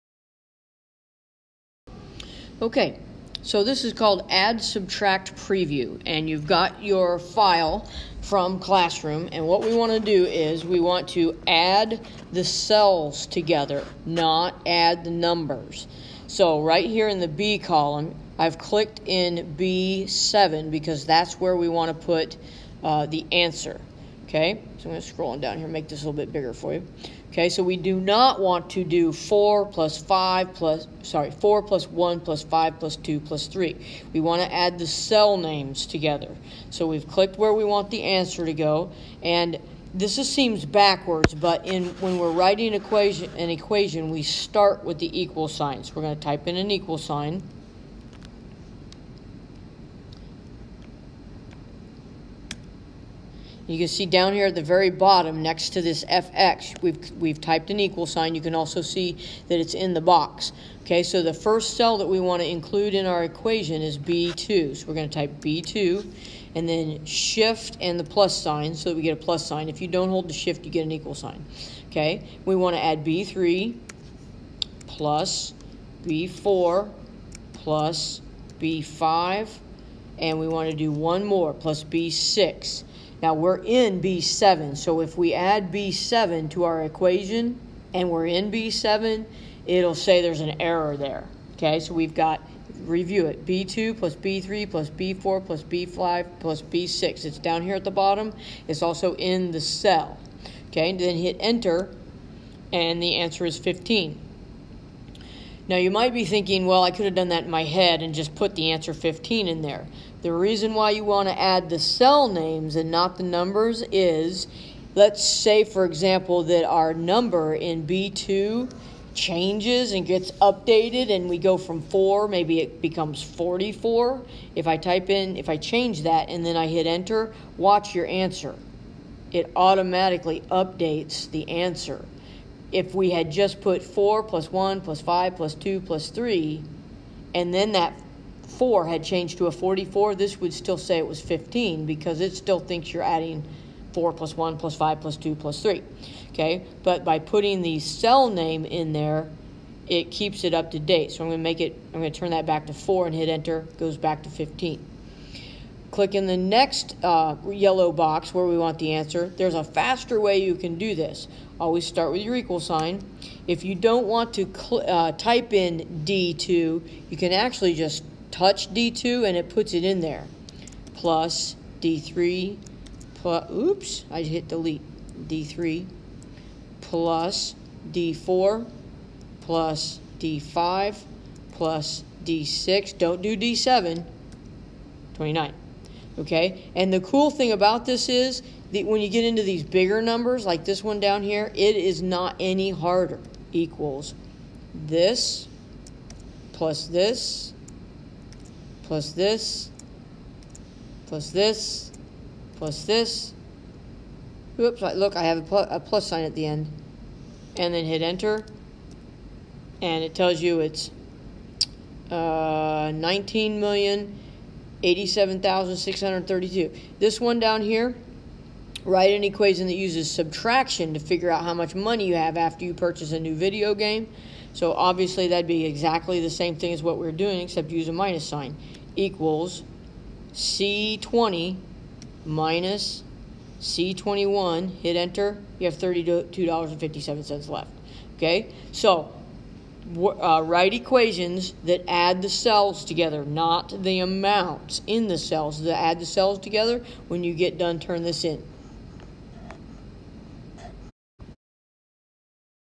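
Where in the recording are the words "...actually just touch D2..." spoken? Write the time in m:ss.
2:47.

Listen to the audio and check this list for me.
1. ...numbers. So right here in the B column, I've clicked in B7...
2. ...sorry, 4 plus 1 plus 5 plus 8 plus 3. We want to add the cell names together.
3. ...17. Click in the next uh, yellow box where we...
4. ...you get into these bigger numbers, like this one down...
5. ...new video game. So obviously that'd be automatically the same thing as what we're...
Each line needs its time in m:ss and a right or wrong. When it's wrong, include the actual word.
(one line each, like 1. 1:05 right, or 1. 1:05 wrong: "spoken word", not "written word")
1. 0:15 right
2. 0:31 wrong: "2", not "8"
3. 2:34 wrong: "15", not "17"
4. 3:09 right
5. 3:43 wrong: "exactly", not "automatically".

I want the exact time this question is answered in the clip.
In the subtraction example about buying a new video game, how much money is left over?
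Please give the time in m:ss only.
3:55.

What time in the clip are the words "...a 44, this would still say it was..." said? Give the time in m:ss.
2:19.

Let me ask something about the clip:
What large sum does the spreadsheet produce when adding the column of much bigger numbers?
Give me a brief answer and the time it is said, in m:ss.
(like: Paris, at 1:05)
19,087,632, at 3:32.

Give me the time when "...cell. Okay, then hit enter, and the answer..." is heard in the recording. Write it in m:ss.
1:39.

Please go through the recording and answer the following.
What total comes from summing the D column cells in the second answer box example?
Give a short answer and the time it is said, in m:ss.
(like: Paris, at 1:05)
29, at 3:05.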